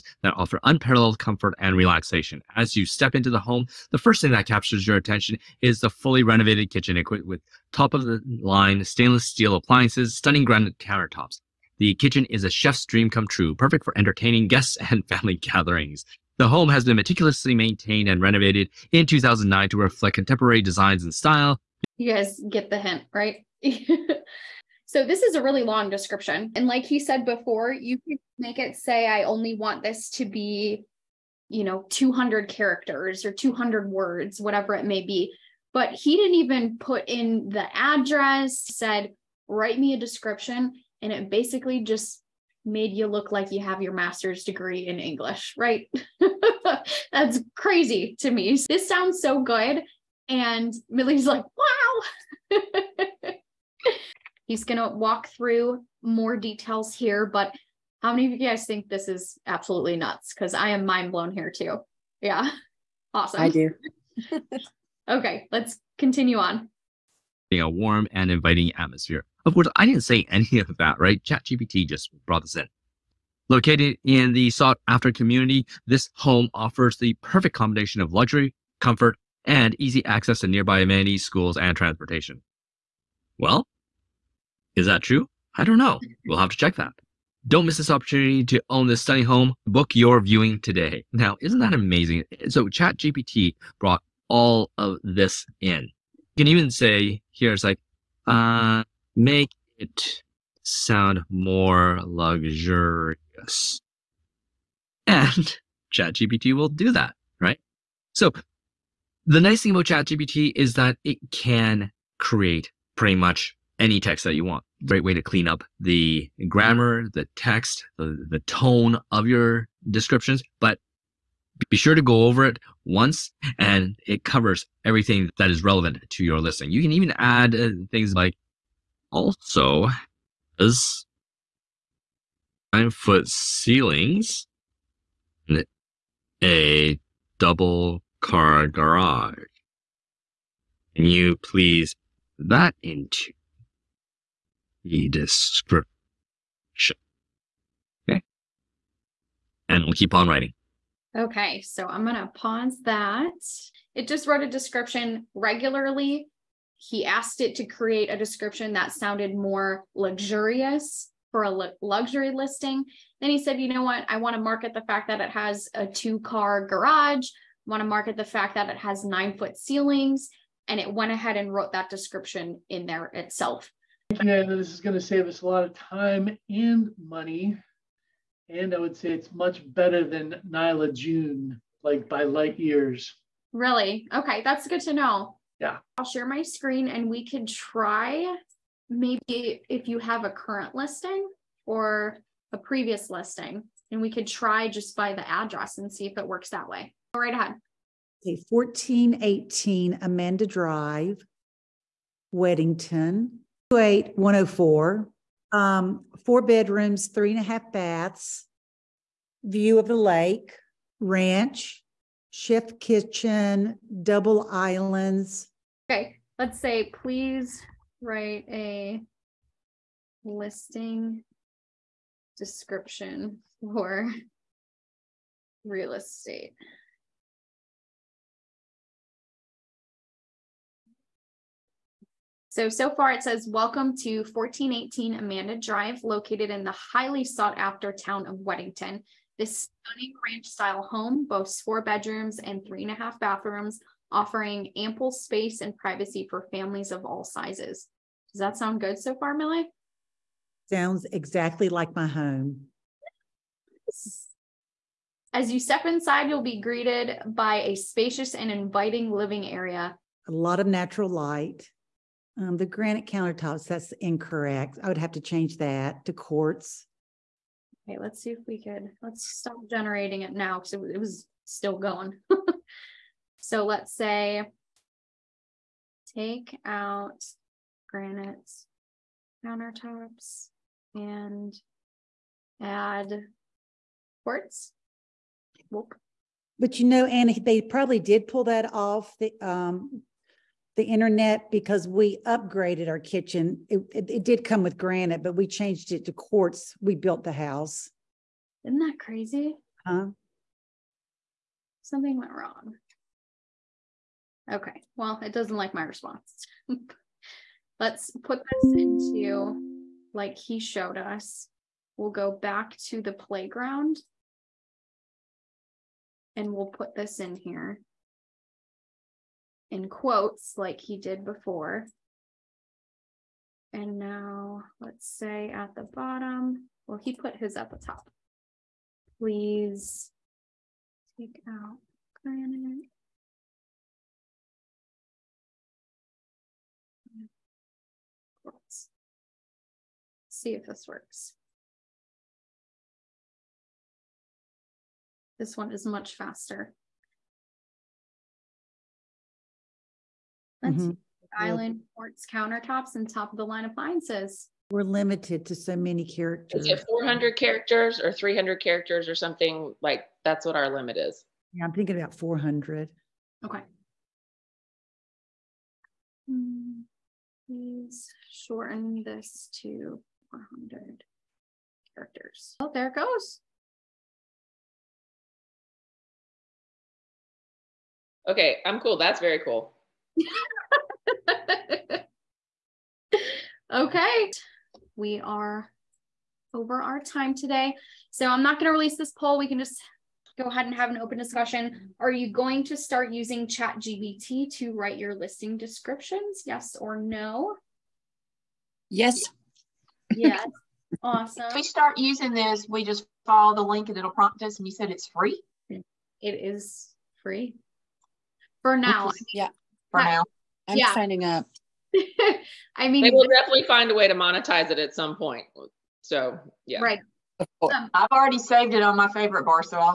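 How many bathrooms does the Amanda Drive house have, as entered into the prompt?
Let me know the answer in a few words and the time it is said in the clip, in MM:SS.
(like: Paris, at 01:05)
3.5, at 03:27.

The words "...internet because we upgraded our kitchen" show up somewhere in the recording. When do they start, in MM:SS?
04:50.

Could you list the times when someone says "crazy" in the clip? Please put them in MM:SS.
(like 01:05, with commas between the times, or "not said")
00:47, 04:58.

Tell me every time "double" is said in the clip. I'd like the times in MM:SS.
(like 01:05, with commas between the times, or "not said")
02:17, 03:34.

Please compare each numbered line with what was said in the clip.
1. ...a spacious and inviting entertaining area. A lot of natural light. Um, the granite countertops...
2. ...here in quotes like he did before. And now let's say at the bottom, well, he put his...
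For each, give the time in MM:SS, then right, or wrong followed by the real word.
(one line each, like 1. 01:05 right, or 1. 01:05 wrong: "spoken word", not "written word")
1. 04:17 wrong: "living", not "entertaining"
2. 05:17 right.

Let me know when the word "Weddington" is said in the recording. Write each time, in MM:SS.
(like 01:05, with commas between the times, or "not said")
03:22, 03:58.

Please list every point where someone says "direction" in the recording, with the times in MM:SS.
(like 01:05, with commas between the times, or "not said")
not said.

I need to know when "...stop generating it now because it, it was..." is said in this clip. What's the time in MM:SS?
04:29.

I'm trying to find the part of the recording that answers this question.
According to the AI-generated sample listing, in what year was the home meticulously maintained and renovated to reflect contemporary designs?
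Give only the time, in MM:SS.
00:19.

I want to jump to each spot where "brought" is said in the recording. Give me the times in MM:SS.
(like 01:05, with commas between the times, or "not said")
01:12, 01:33.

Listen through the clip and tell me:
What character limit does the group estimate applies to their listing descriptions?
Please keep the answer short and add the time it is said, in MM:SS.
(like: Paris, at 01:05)
400, at 06:01.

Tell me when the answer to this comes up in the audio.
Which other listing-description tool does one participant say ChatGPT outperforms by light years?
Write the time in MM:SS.
03:00.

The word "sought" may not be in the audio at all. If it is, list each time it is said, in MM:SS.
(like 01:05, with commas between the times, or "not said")
01:14, 03:57.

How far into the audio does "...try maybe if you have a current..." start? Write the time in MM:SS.
03:07.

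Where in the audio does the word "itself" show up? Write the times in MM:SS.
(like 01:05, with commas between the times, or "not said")
02:53.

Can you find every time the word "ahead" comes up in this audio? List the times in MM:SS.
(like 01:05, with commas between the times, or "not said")
02:51, 03:17, 06:30.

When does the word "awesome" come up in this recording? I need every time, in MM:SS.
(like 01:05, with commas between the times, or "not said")
01:03, 06:41.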